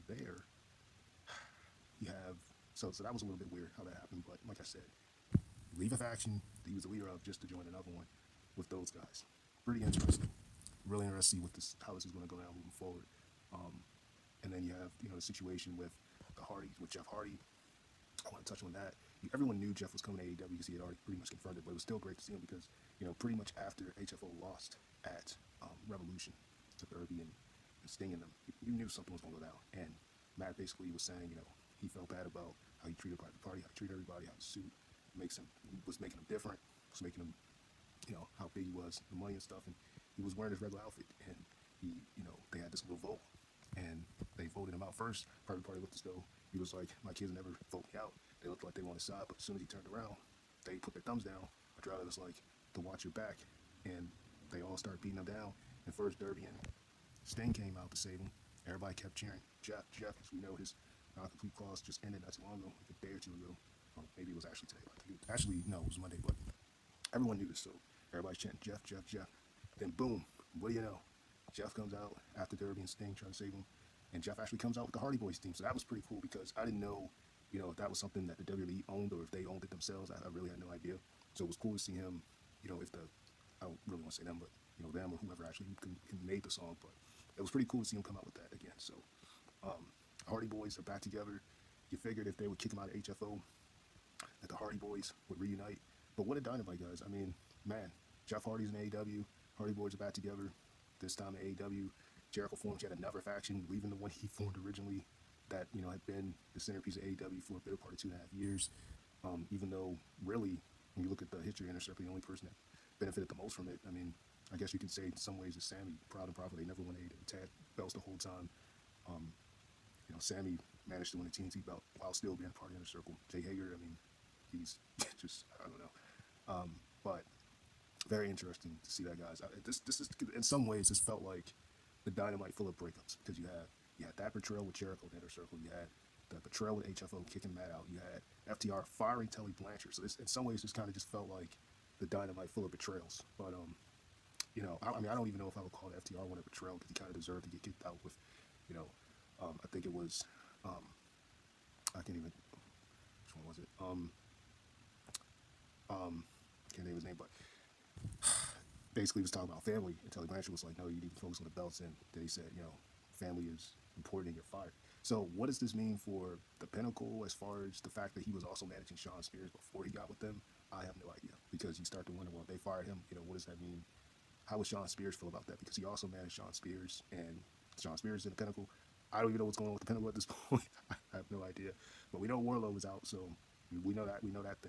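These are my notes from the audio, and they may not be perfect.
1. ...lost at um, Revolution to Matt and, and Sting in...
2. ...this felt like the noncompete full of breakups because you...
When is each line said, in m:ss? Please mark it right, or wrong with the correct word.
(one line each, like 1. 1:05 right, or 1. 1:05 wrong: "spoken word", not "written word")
1. 0:24 wrong: "Darby", not "Matt"
2. 2:10 wrong: "dynamite", not "noncompete".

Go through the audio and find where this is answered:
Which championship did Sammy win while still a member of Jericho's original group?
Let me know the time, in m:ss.
2:01.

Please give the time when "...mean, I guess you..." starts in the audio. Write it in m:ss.
1:53.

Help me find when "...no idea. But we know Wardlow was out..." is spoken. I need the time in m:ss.
3:01.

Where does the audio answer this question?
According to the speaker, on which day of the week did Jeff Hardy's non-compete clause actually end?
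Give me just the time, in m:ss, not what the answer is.
1:05.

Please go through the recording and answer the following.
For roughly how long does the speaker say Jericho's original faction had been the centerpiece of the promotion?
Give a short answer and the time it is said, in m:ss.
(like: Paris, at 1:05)
Two and a half years, at 1:47.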